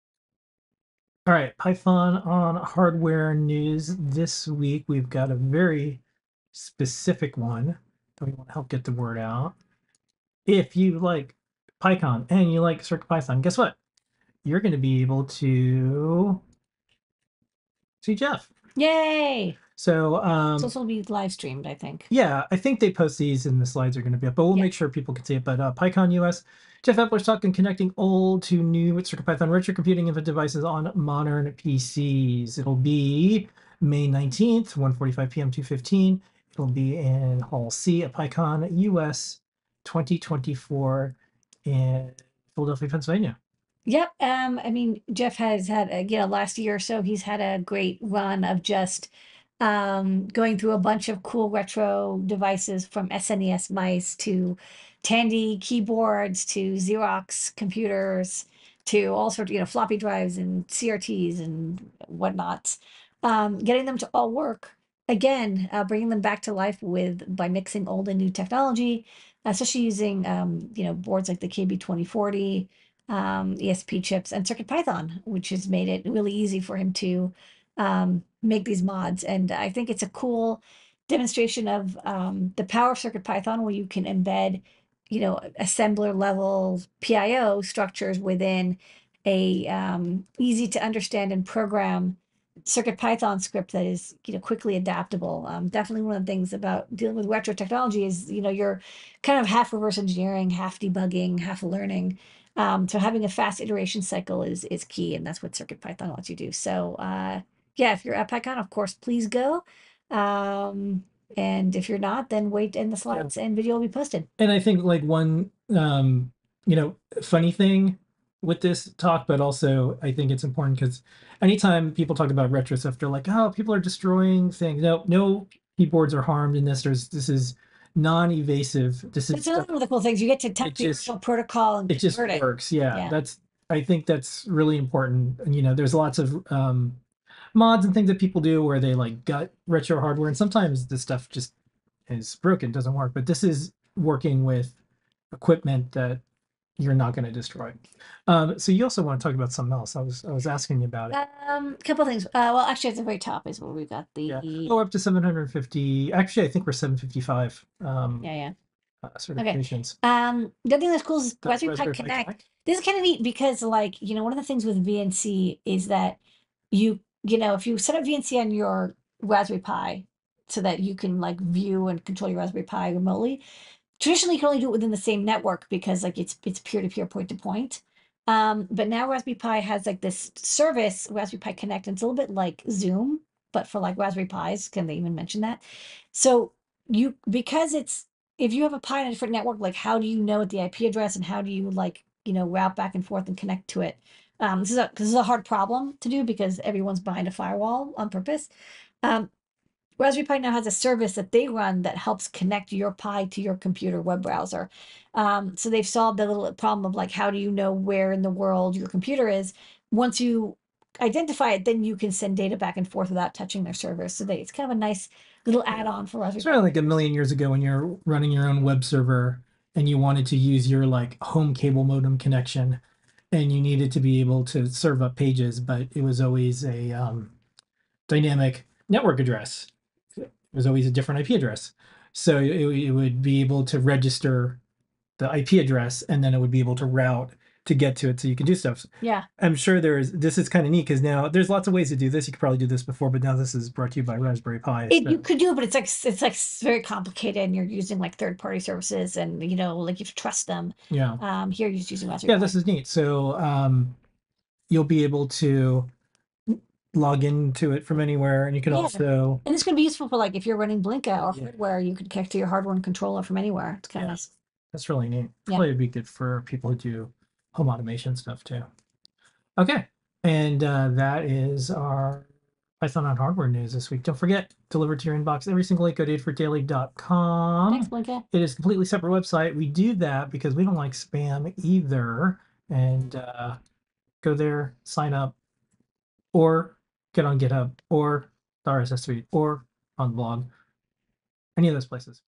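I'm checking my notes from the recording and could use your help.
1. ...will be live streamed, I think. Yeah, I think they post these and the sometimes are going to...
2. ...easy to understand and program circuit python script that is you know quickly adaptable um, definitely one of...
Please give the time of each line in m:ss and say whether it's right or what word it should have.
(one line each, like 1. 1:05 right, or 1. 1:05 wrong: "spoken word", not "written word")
1. 0:20 wrong: "slides", not "sometimes"
2. 1:30 right.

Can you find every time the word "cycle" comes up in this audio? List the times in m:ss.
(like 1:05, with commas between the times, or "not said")
1:44.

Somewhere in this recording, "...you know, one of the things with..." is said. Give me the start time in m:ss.
2:44.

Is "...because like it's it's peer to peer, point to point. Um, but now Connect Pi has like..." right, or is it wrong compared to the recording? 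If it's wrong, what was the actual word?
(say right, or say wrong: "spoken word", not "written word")
wrong: "Raspberry", not "Connect".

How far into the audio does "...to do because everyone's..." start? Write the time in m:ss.
3:15.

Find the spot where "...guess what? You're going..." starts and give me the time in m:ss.
0:13.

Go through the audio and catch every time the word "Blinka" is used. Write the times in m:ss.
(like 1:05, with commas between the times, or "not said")
4:20, 4:37.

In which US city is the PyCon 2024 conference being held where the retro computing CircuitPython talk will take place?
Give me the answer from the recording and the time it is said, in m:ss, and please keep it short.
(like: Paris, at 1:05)
Philadelphia, at 0:42.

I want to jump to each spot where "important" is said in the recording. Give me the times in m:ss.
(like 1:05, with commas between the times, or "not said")
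2:00, 2:14.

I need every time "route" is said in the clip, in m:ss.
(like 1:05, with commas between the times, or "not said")
3:12, 3:56.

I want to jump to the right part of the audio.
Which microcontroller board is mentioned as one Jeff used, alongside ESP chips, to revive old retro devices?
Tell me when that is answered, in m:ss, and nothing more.
1:11.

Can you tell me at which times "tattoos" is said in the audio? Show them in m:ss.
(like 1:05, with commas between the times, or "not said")
not said.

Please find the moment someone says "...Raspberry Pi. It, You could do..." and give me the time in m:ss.
4:04.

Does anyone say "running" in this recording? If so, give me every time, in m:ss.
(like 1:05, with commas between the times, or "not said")
3:38, 4:20.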